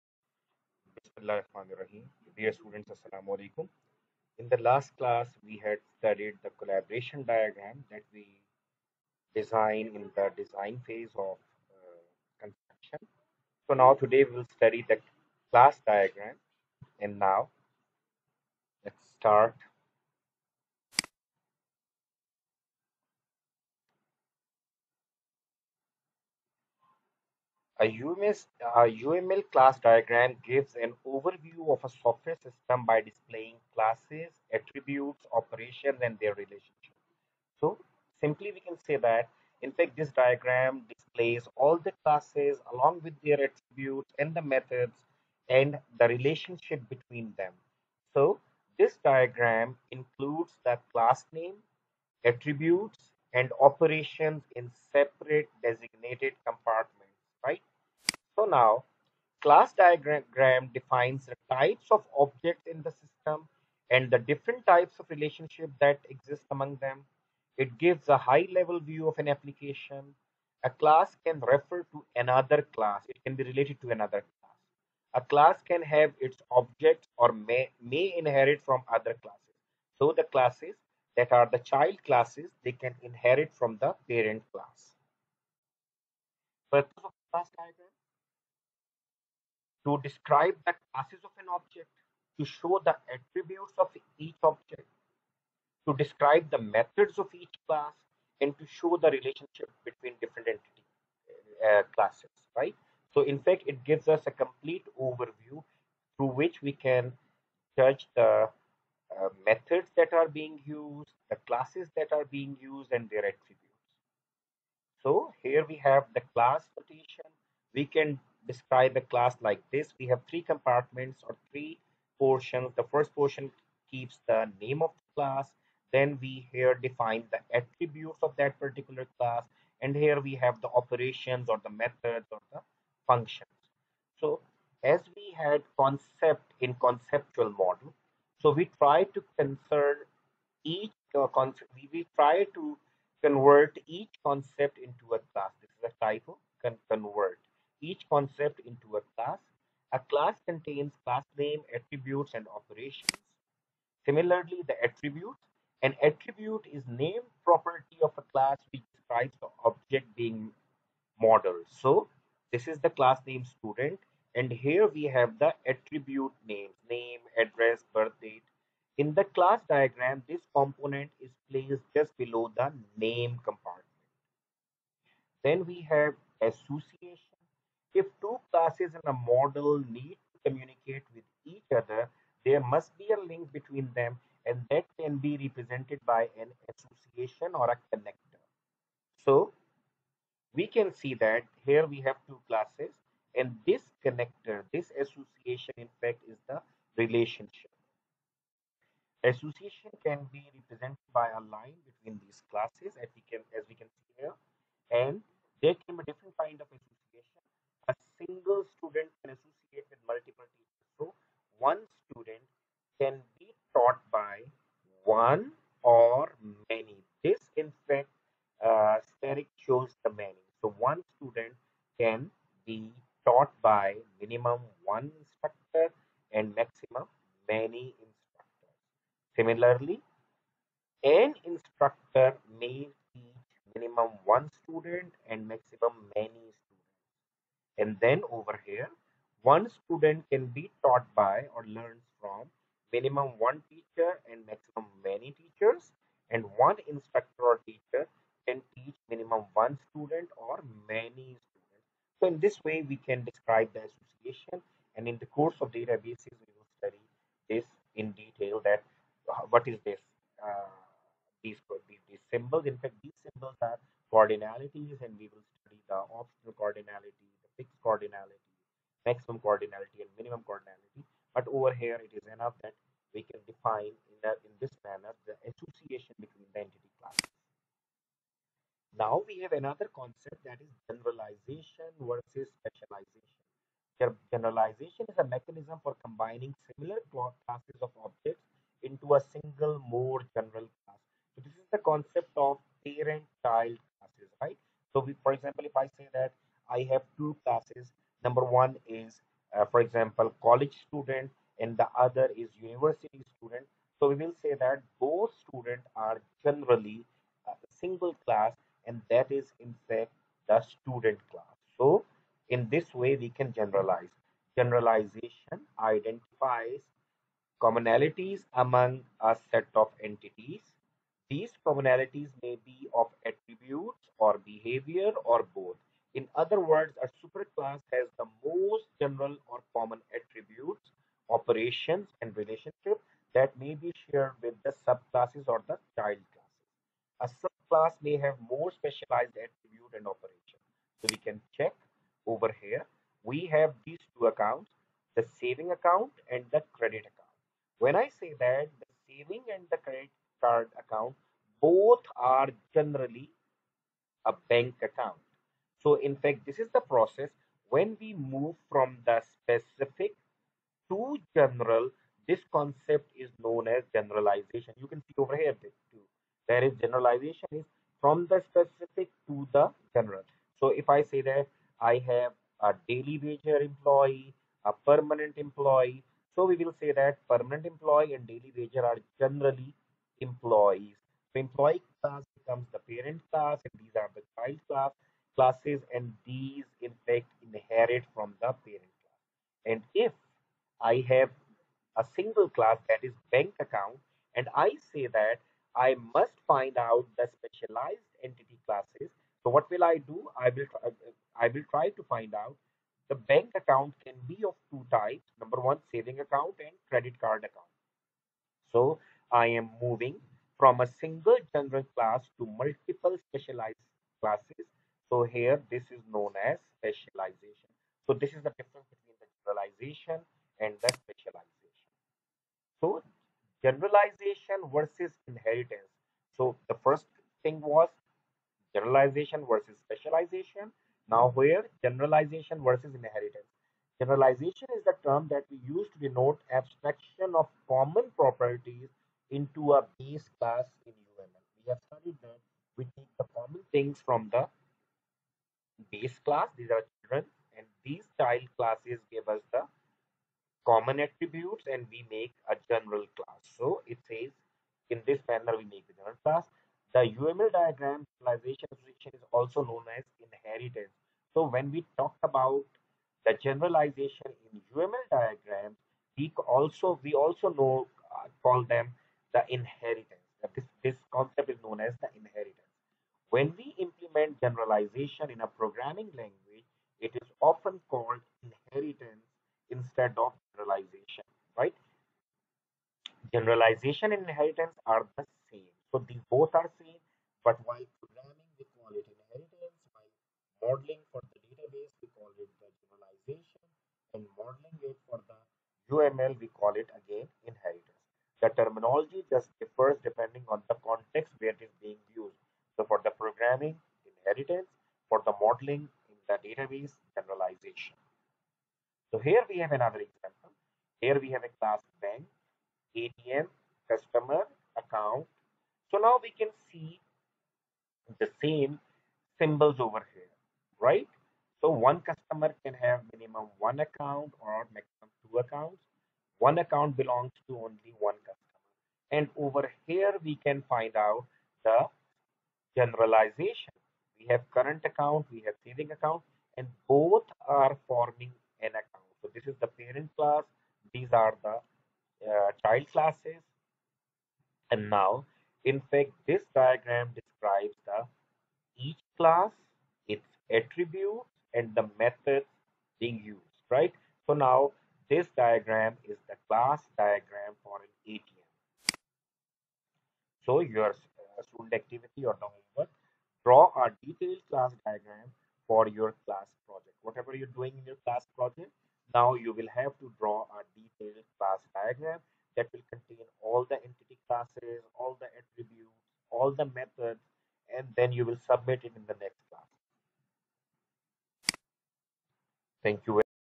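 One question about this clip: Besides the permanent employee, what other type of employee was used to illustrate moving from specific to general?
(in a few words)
Daily wager employee.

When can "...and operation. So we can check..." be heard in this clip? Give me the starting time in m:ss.
5:39.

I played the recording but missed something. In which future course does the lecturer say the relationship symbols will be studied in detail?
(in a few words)
Databases.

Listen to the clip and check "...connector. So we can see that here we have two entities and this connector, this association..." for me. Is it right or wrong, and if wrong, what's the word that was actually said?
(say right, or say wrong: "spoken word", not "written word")
wrong: "classes", not "entities".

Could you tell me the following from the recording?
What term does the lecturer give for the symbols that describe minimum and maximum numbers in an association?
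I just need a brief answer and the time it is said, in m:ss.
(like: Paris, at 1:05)
Cardinalities, at 4:24.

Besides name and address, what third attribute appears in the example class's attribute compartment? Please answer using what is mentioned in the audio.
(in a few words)
Birth date.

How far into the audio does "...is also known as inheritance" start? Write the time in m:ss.
7:39.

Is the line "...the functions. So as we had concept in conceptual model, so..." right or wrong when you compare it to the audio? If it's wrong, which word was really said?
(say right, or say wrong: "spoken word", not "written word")
right.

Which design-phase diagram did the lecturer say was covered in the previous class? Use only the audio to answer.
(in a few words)
Collaboration diagram.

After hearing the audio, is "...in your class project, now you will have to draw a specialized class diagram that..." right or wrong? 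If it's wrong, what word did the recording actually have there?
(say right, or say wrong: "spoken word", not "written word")
wrong: "detailed", not "specialized".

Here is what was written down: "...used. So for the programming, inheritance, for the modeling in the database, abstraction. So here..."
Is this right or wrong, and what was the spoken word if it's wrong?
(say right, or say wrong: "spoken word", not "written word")
wrong: "generalization", not "abstraction".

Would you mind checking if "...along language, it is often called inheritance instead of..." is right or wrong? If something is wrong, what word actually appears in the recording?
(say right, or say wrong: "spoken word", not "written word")
wrong: "programming", not "along".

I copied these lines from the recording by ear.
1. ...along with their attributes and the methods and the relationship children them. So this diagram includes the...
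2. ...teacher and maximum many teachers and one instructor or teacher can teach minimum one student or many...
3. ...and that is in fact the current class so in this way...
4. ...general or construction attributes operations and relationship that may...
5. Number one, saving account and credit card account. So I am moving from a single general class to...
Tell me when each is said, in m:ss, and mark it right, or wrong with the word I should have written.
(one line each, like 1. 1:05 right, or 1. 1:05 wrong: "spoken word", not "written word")
1. 0:42 wrong: "between", not "children"
2. 4:03 right
3. 5:08 wrong: "student", not "current"
4. 5:28 wrong: "common", not "construction"
5. 6:45 right.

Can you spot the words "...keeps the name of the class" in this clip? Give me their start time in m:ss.
2:03.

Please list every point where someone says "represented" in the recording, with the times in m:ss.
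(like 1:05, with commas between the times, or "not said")
3:05, 3:20.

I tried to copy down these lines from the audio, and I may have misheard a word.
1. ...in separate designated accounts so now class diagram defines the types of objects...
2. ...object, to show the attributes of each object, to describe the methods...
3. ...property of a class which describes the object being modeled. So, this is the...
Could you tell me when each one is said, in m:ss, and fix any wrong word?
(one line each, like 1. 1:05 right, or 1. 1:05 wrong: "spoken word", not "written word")
1. 0:54 wrong: "compartments", not "accounts"
2. 1:31 right
3. 2:37 right.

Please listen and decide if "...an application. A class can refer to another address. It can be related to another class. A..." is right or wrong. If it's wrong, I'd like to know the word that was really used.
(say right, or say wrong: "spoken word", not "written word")
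wrong: "class", not "address".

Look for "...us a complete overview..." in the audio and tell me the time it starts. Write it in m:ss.
1:44.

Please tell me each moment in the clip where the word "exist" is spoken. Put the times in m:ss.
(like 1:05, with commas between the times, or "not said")
1:06.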